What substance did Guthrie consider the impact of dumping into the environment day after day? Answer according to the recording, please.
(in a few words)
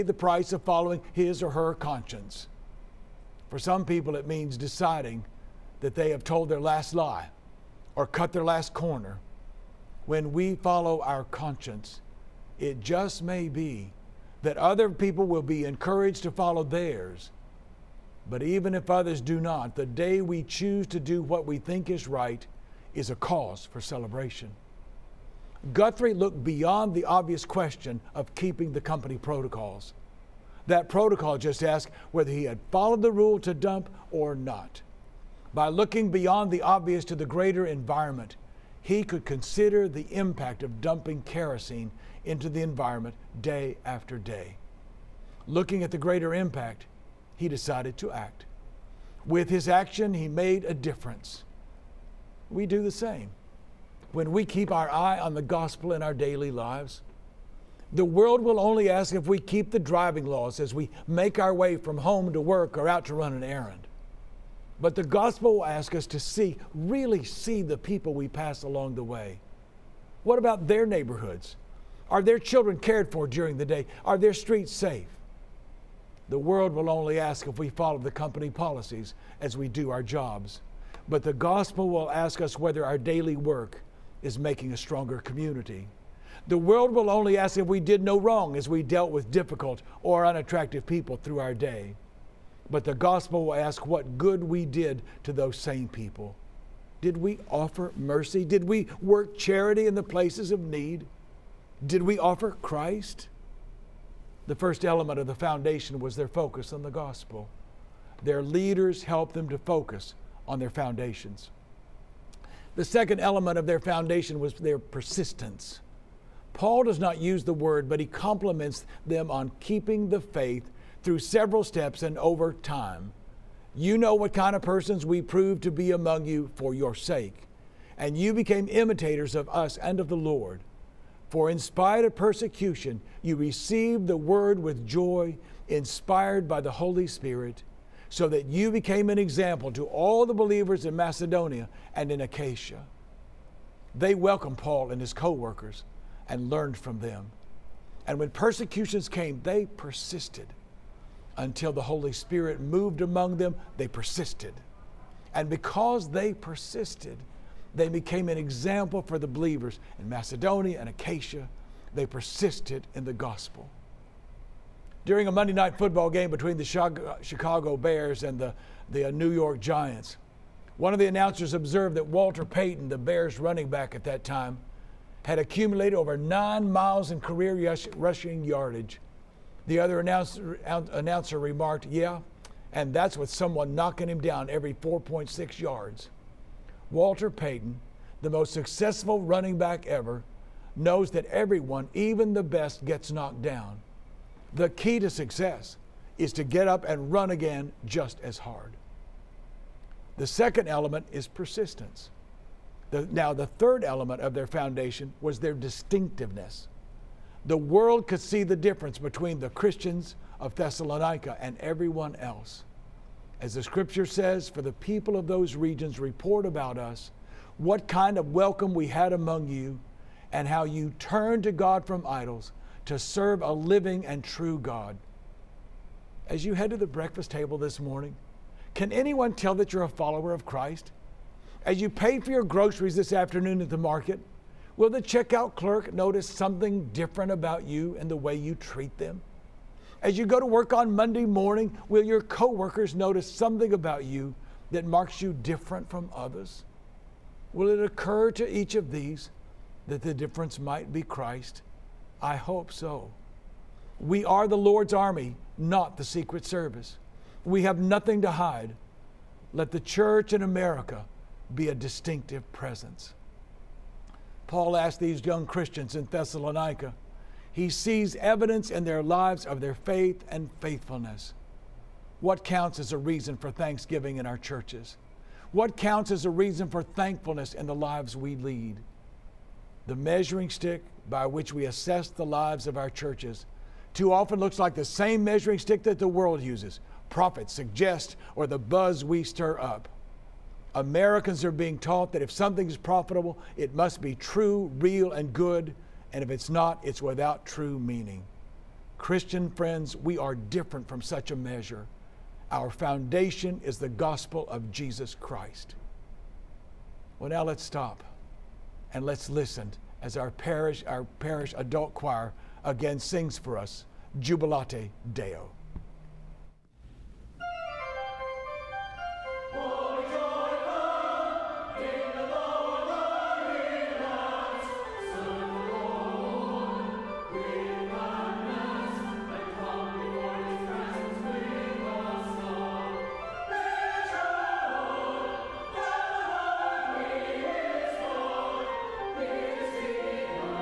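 Kerosene.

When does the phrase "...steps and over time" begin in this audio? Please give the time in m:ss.
2:01.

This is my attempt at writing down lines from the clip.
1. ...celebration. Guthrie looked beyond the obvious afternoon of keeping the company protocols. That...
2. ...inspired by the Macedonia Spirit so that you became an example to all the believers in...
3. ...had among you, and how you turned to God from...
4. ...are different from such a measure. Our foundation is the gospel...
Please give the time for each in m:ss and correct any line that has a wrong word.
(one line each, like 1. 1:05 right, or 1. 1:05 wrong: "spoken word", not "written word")
1. 0:23 wrong: "question", not "afternoon"
2. 2:15 wrong: "Holy", not "Macedonia"
3. 3:38 right
4. 5:00 right.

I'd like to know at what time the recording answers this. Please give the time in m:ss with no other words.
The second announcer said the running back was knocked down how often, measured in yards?
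3:04.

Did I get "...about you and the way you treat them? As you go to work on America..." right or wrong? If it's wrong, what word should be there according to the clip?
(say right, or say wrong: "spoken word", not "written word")
wrong: "Monday", not "America".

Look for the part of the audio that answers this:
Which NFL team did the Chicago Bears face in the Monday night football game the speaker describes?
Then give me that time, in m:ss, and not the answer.
2:49.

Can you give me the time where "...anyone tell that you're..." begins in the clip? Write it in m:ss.
3:48.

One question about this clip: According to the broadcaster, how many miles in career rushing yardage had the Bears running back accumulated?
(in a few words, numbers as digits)
9.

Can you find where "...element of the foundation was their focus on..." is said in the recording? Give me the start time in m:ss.
1:44.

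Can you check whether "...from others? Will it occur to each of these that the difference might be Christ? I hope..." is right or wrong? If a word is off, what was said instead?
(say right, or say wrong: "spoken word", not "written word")
right.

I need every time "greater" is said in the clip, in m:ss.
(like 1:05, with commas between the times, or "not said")
0:37, 0:45.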